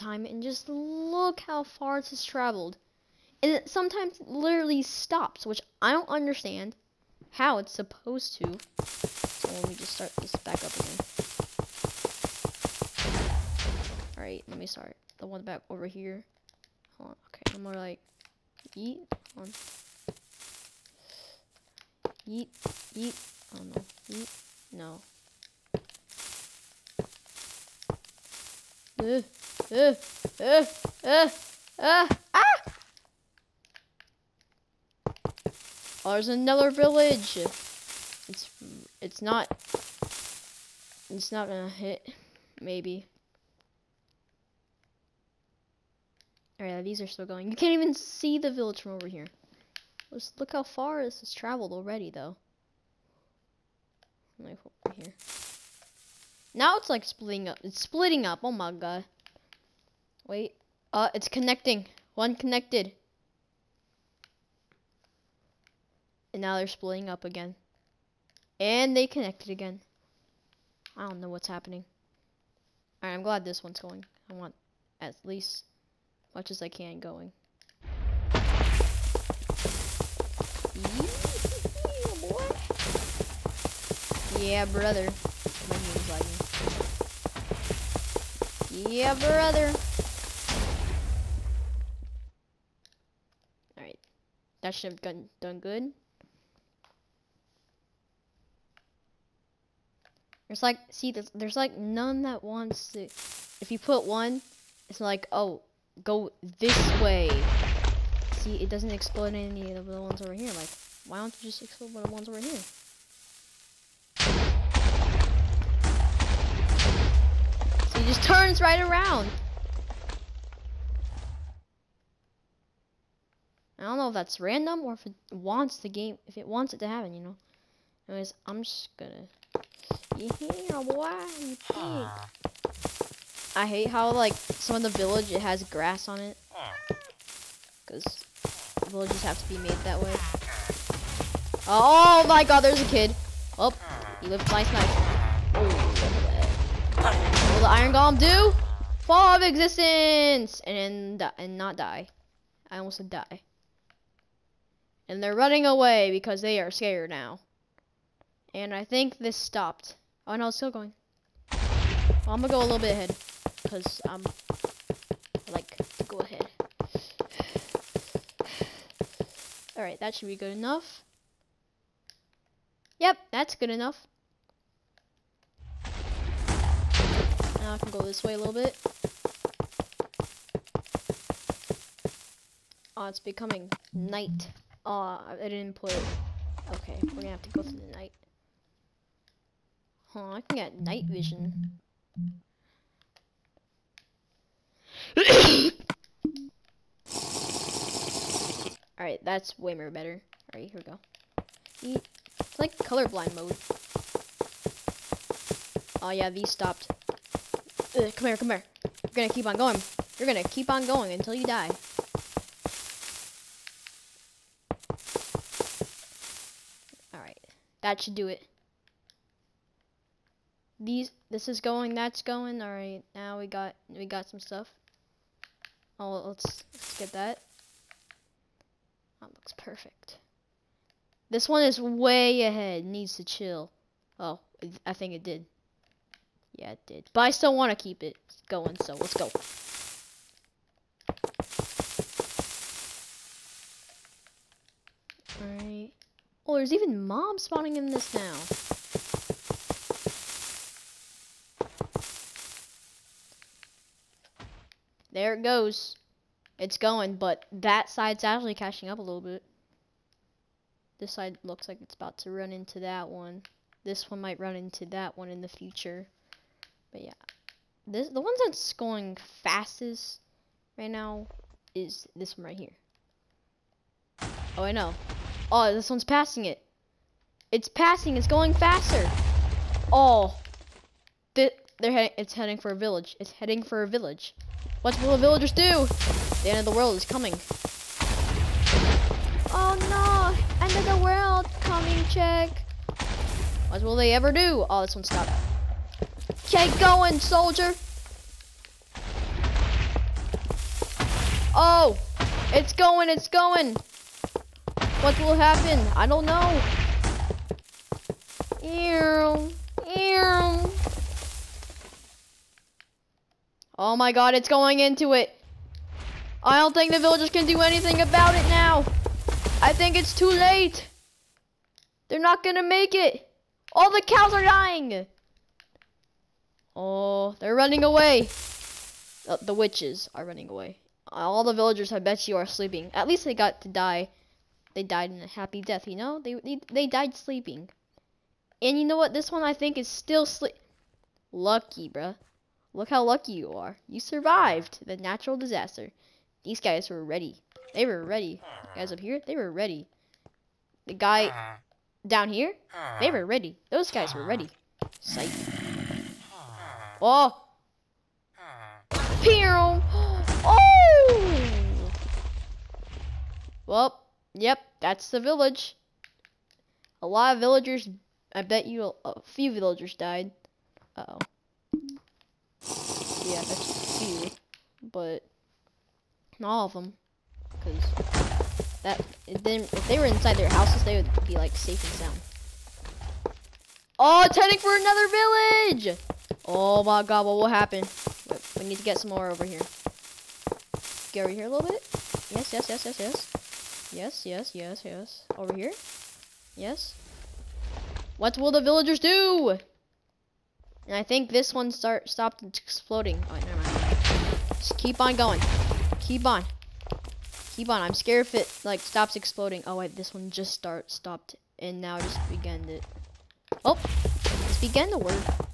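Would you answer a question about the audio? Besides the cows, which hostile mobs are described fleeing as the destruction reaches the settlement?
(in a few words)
The witches.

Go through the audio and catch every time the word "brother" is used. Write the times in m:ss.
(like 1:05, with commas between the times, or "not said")
1:24, 1:29.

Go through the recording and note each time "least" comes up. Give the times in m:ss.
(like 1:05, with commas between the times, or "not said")
1:15, 5:33.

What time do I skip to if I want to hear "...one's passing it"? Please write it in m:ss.
4:35.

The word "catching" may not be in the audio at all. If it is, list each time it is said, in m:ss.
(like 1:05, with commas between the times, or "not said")
4:18.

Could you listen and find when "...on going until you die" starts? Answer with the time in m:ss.
3:30.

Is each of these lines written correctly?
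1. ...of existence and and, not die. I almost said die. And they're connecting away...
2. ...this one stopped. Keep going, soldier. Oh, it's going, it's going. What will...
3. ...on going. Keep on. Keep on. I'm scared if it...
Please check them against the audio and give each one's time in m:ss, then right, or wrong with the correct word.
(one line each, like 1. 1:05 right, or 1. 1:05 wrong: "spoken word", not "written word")
1. 2:29 wrong: "running", not "connecting"
2. 4:54 right
3. 6:45 right.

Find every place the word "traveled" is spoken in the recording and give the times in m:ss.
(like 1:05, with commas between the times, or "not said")
0:02, 0:51.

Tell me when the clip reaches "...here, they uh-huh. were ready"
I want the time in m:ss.
5:52.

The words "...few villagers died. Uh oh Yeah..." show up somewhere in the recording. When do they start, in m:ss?
6:09.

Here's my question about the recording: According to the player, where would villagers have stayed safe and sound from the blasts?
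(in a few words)
Inside their houses.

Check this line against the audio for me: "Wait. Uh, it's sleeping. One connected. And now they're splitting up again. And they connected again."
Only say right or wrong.
wrong.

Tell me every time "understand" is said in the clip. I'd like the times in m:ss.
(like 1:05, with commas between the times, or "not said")
0:06.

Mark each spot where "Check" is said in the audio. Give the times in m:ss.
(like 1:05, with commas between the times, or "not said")
4:52.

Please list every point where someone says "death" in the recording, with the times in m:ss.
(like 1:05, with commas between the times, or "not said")
5:35.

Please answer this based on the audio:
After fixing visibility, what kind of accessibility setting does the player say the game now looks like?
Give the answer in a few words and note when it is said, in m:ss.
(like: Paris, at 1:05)
Colorblind mode, at 3:22.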